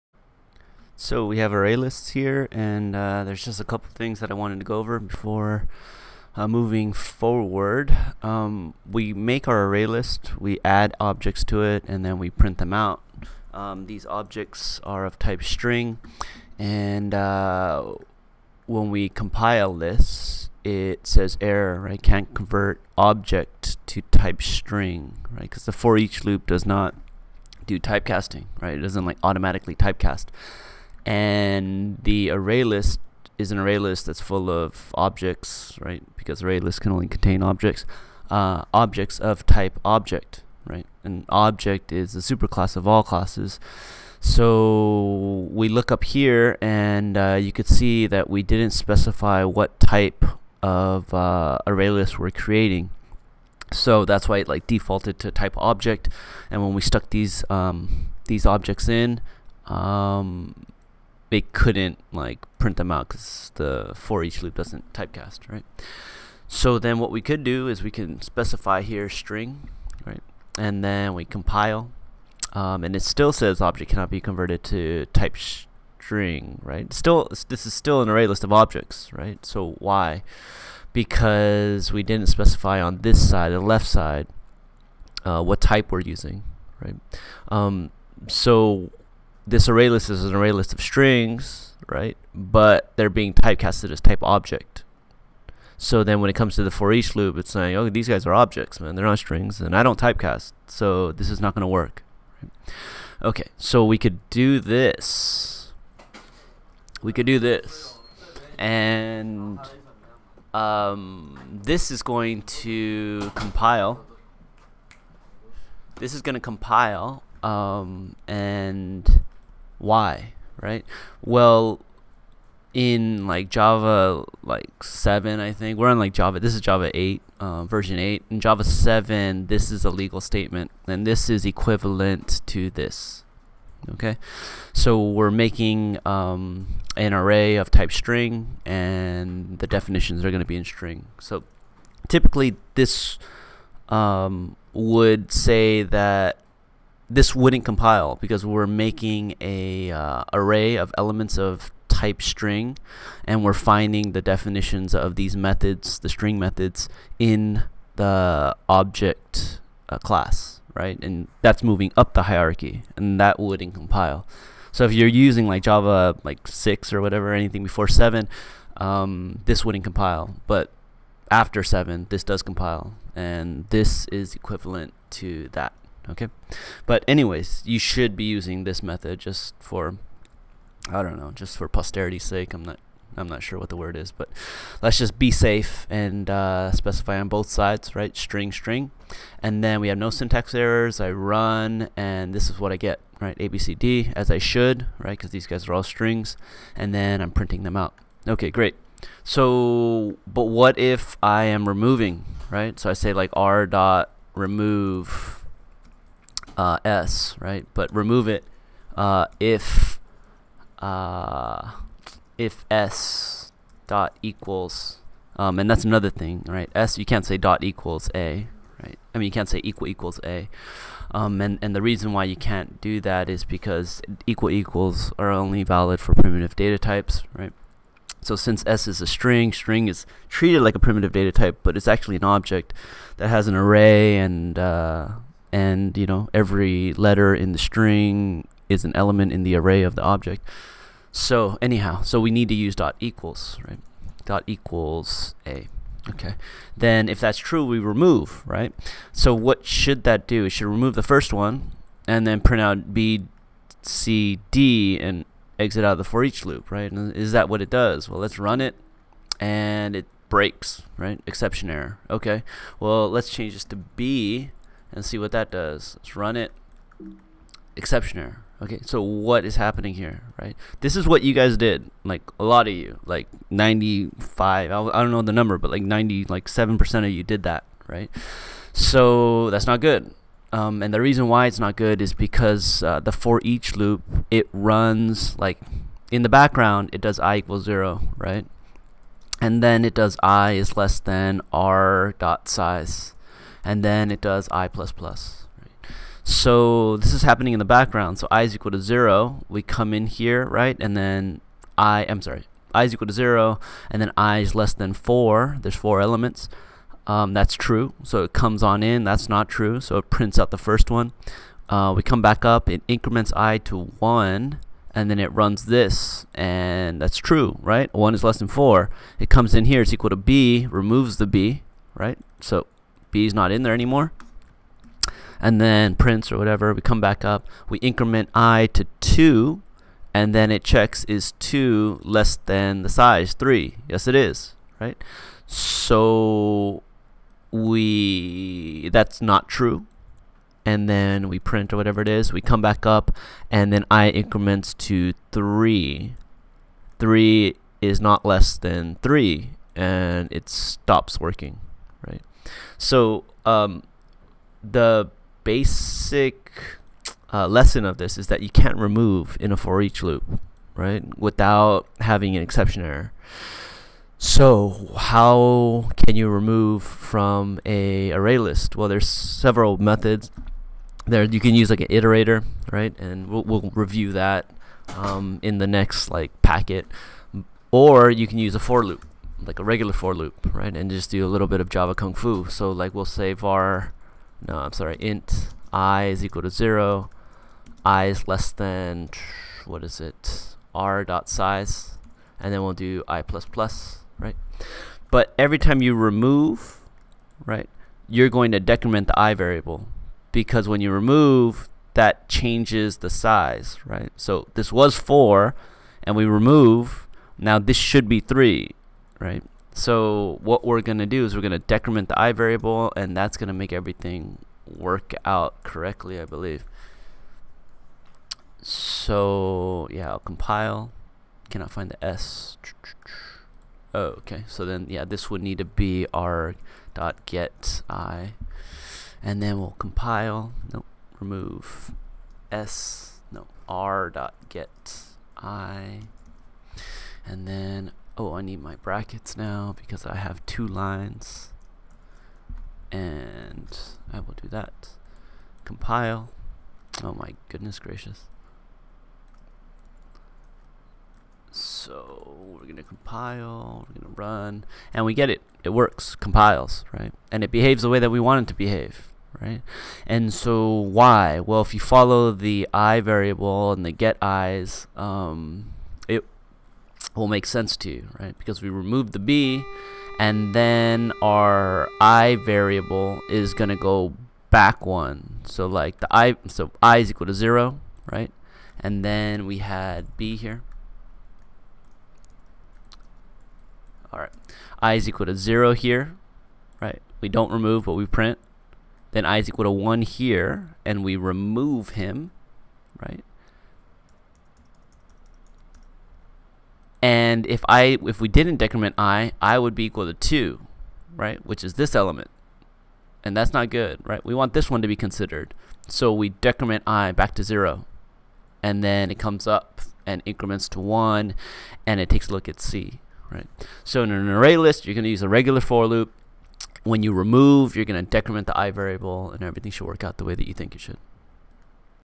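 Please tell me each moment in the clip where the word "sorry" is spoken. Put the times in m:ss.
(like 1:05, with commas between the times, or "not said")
5:02, 6:24.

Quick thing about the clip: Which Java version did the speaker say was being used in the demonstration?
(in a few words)
Java 8.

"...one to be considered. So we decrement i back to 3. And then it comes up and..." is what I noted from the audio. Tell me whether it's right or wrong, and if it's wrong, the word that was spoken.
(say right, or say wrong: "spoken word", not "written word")
wrong: "0", not "3".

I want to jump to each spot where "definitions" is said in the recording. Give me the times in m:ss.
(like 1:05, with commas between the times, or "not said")
2:19, 2:34.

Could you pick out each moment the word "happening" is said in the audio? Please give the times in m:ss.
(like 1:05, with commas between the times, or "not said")
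4:29, 4:57.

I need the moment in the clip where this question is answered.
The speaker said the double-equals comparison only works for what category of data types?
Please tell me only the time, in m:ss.
3:46.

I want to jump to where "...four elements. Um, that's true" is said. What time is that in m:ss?
5:05.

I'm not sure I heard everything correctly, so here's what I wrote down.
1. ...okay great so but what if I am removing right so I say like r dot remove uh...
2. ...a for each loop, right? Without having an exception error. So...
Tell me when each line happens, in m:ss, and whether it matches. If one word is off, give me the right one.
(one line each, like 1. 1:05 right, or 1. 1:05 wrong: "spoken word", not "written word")
1. 3:18 right
2. 5:59 right.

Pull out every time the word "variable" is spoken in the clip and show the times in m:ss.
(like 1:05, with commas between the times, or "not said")
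6:39, 6:52, 7:43, 7:52, 8:38.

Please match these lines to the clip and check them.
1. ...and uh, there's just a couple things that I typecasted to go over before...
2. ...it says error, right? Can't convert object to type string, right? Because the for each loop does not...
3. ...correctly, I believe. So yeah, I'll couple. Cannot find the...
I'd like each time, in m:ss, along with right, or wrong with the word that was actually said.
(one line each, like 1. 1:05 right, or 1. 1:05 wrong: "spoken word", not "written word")
1. 0:02 wrong: "wanted", not "typecasted"
2. 0:20 right
3. 6:55 wrong: "compile", not "couple".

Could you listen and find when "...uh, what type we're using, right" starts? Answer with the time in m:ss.
1:25.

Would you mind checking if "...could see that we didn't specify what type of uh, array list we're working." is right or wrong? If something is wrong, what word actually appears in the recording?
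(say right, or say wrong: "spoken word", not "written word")
wrong: "creating", not "working".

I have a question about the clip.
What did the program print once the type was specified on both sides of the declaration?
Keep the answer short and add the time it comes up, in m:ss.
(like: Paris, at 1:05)
ABCD, at 3:13.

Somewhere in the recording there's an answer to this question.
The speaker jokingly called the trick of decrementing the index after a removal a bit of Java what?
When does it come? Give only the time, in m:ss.
6:21.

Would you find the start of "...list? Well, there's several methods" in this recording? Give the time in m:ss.
6:08.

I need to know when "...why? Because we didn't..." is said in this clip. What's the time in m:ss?
1:19.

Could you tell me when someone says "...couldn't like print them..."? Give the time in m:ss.
1:01.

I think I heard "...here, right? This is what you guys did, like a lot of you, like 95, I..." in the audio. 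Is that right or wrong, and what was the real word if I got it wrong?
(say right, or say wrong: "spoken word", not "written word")
right.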